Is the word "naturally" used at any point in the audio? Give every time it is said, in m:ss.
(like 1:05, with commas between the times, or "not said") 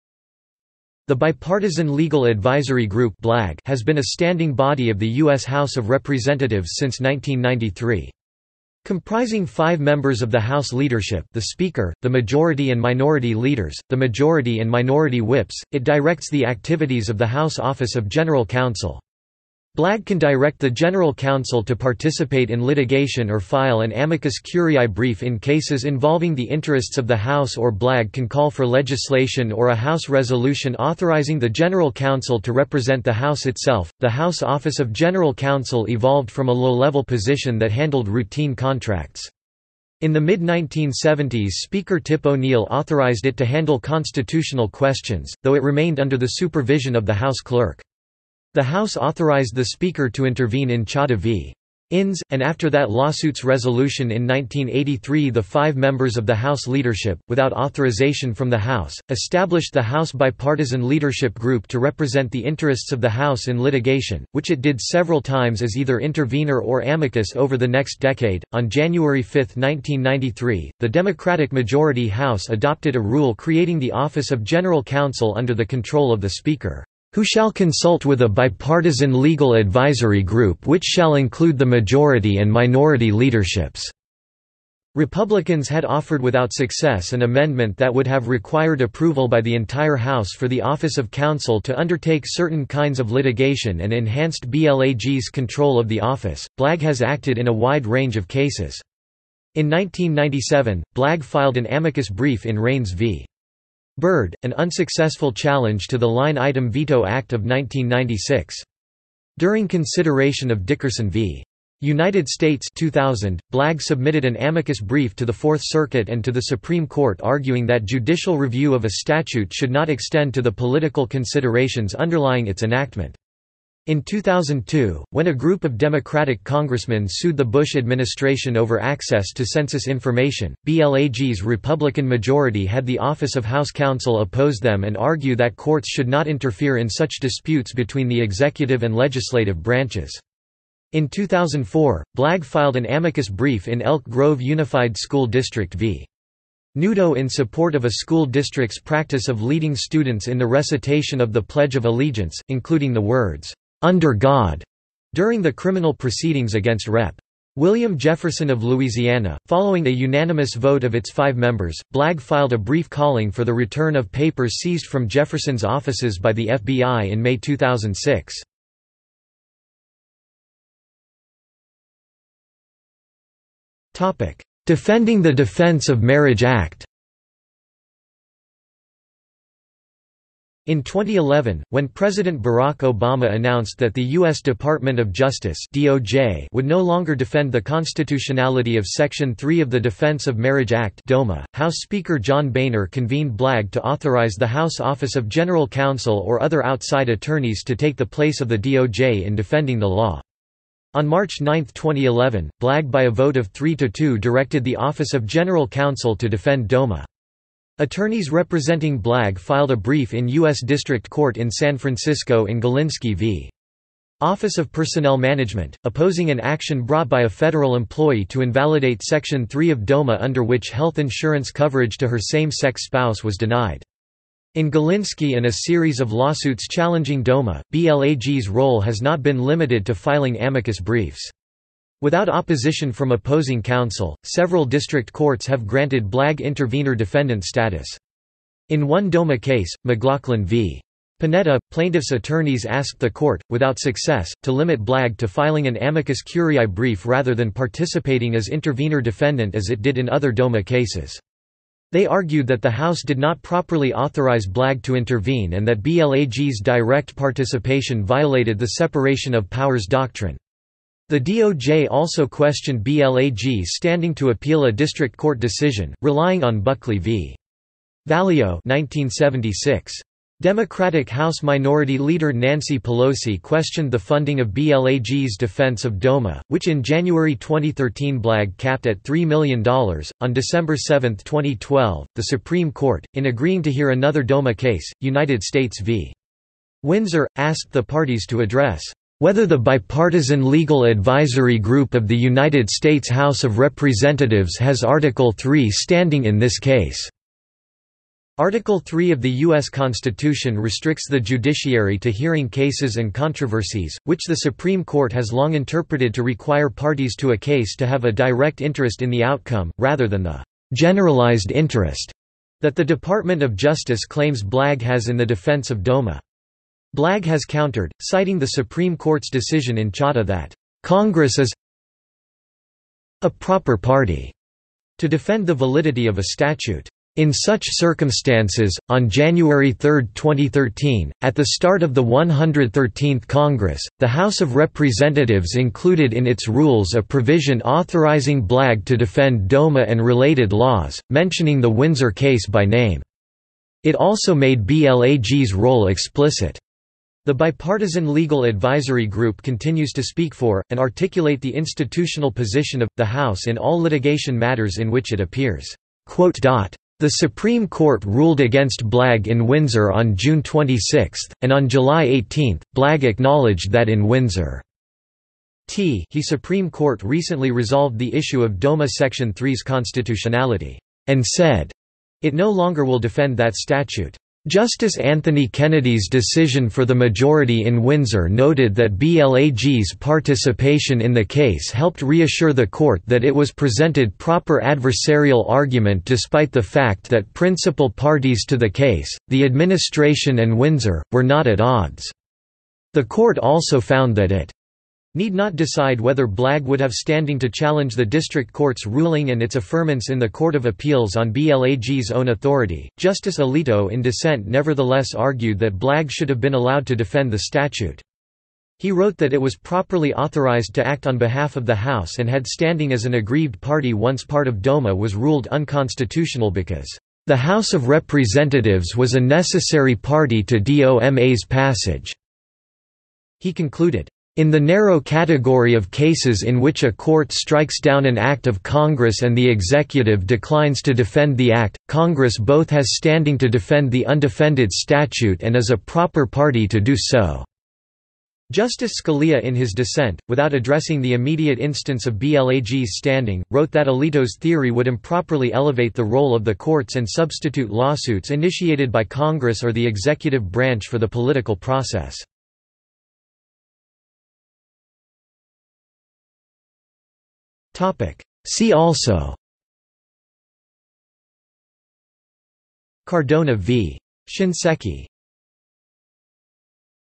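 not said.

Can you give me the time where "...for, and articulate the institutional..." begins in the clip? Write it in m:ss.
5:50.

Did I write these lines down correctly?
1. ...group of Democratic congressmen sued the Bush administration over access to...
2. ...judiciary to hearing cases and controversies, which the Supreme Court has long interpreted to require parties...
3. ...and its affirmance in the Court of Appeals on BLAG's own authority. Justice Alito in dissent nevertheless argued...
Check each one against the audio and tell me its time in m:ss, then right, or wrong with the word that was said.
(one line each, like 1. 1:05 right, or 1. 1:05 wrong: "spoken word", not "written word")
1. 2:05 right
2. 5:01 right
3. 6:39 right.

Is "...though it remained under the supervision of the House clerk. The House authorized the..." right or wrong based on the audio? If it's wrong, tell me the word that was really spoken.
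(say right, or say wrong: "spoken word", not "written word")
right.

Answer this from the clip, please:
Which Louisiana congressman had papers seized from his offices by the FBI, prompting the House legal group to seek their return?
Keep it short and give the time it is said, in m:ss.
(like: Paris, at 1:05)
William Jefferson, at 2:37.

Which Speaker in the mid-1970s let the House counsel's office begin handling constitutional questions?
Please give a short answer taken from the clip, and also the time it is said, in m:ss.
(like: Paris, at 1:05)
Tip O'Neill, at 0:42.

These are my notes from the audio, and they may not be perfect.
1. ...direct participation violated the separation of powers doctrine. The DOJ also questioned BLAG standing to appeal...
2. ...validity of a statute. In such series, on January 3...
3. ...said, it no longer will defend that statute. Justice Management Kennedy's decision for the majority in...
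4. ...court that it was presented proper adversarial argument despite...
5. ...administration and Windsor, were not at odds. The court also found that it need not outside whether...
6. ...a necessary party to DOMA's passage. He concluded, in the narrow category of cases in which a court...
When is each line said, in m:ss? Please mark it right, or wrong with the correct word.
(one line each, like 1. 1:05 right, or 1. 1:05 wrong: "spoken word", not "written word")
1. 4:16 right
2. 5:25 wrong: "circumstances", not "series"
3. 6:11 wrong: "Anthony", not "Management"
4. 6:22 right
5. 6:29 wrong: "decide", not "outside"
6. 6:59 right.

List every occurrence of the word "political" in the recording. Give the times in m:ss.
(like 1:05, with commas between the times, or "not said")
2:00, 7:31.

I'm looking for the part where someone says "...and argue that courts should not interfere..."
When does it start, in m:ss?
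2:14.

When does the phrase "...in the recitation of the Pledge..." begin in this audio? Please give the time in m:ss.
2:30.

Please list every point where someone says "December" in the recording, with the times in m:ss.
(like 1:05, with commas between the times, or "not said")
4:40.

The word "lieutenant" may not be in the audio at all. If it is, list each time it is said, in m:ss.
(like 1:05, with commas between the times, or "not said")
not said.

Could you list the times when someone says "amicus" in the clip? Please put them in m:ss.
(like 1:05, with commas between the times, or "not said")
0:23, 1:06, 1:41, 1:54, 2:22, 3:50, 4:05.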